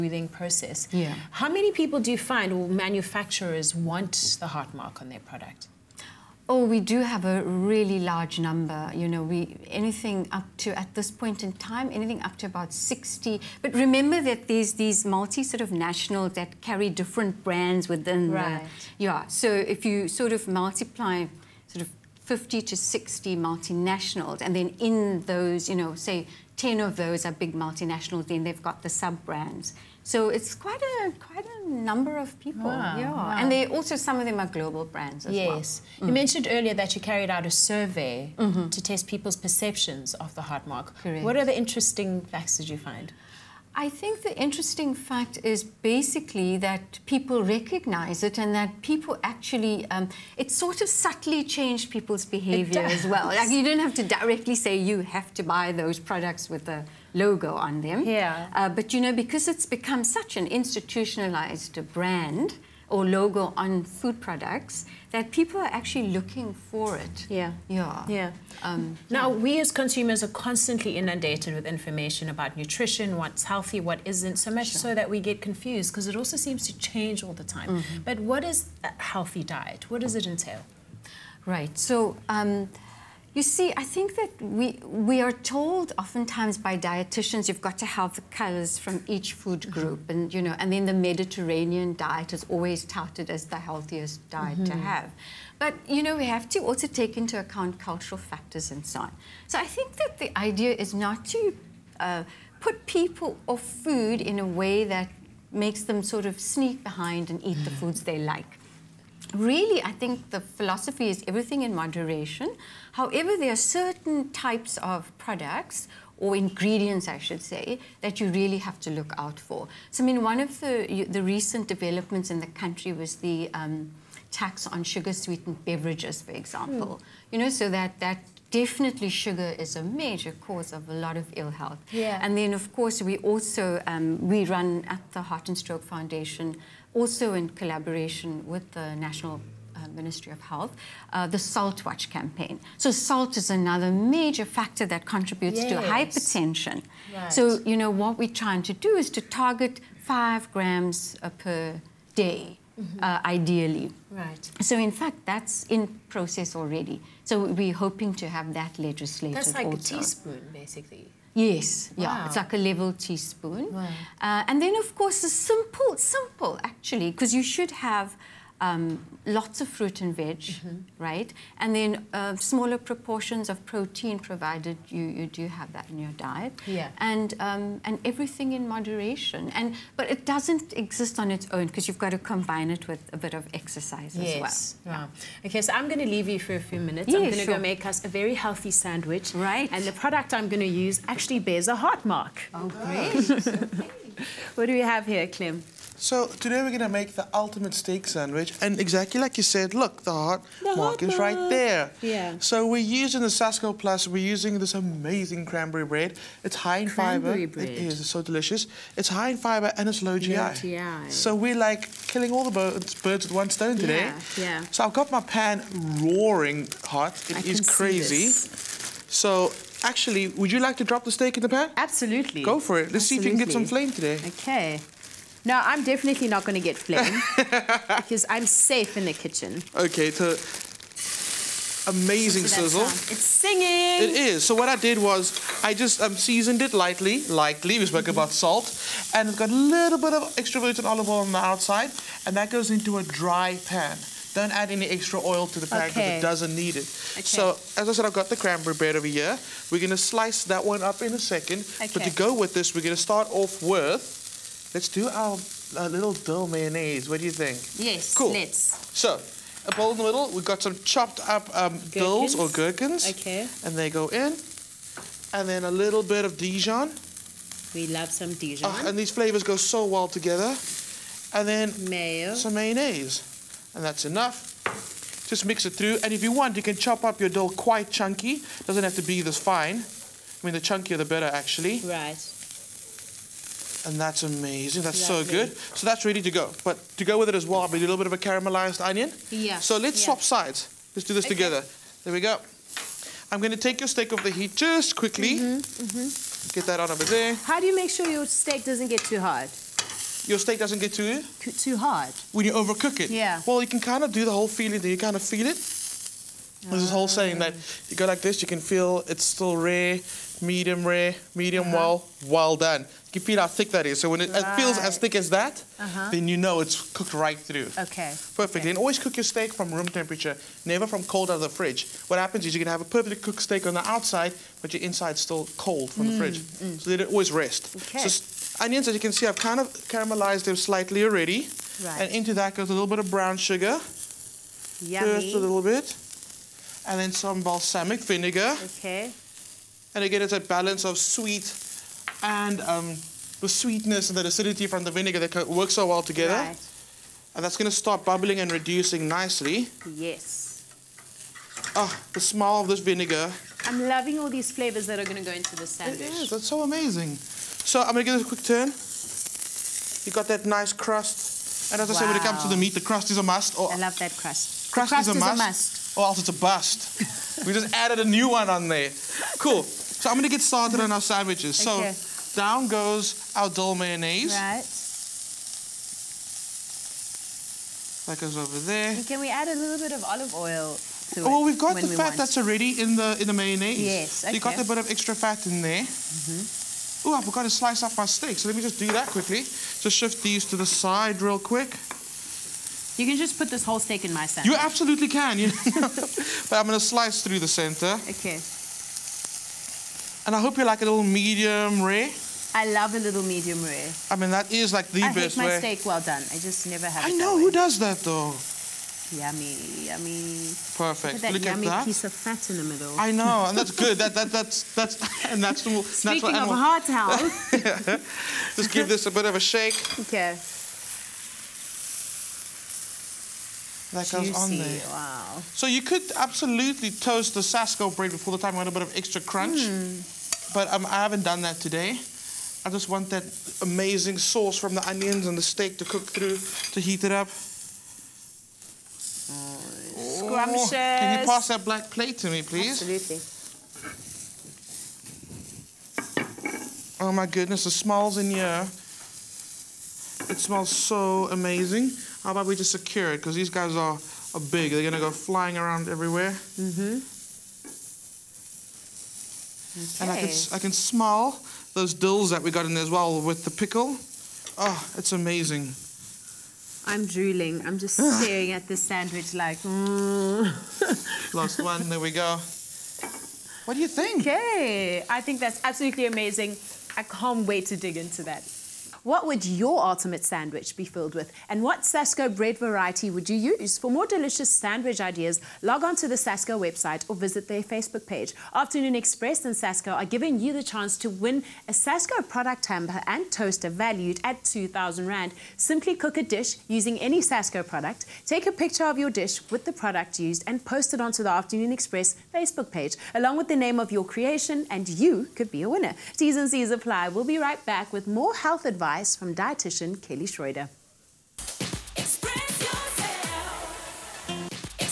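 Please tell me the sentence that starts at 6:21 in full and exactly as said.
Well, we've got the we fat want.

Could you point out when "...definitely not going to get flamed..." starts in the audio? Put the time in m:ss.
3:45.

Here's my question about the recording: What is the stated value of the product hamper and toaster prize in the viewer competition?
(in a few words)
2,000 Rand.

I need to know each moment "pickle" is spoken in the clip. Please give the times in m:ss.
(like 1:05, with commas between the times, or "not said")
7:43.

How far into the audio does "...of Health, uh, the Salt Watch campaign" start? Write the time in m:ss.
2:20.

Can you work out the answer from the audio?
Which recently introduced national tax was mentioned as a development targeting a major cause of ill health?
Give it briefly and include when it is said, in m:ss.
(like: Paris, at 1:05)
tax on sugar-sweetened beverages, at 2:04.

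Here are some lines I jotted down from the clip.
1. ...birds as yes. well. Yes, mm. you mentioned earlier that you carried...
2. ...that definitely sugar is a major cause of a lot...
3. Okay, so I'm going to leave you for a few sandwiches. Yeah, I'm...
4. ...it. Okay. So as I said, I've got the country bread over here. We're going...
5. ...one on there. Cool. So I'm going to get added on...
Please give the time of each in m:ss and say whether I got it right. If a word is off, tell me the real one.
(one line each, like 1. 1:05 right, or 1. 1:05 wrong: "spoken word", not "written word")
1. 0:34 wrong: "brands", not "birds"
2. 2:07 right
3. 3:05 wrong: "minutes", not "sandwiches"
4. 4:06 wrong: "cranberry", not "country"
5. 6:08 wrong: "started", not "added".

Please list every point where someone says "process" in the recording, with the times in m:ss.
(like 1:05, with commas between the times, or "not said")
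0:00, 2:36.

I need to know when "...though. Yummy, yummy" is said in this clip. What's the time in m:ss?
6:47.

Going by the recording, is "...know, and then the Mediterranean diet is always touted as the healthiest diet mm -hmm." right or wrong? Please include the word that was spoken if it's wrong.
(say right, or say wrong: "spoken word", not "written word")
right.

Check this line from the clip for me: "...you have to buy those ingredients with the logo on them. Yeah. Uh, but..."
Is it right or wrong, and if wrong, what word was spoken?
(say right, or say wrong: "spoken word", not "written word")
wrong: "products", not "ingredients".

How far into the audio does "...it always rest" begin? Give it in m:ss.
5:26.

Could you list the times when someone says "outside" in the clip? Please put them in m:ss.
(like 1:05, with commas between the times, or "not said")
4:01, 5:23.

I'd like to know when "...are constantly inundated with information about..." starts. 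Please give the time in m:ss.
1:10.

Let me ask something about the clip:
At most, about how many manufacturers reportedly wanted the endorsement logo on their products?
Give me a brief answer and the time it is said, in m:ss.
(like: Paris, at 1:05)
60, at 0:12.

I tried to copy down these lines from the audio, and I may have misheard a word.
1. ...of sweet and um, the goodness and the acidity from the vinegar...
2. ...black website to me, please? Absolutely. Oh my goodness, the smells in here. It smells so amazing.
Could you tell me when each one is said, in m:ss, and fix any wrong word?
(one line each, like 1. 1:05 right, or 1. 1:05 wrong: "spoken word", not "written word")
1. 5:40 wrong: "sweetness", not "goodness"
2. 7:21 wrong: "plate", not "website".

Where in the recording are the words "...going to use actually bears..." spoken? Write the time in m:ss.
3:10.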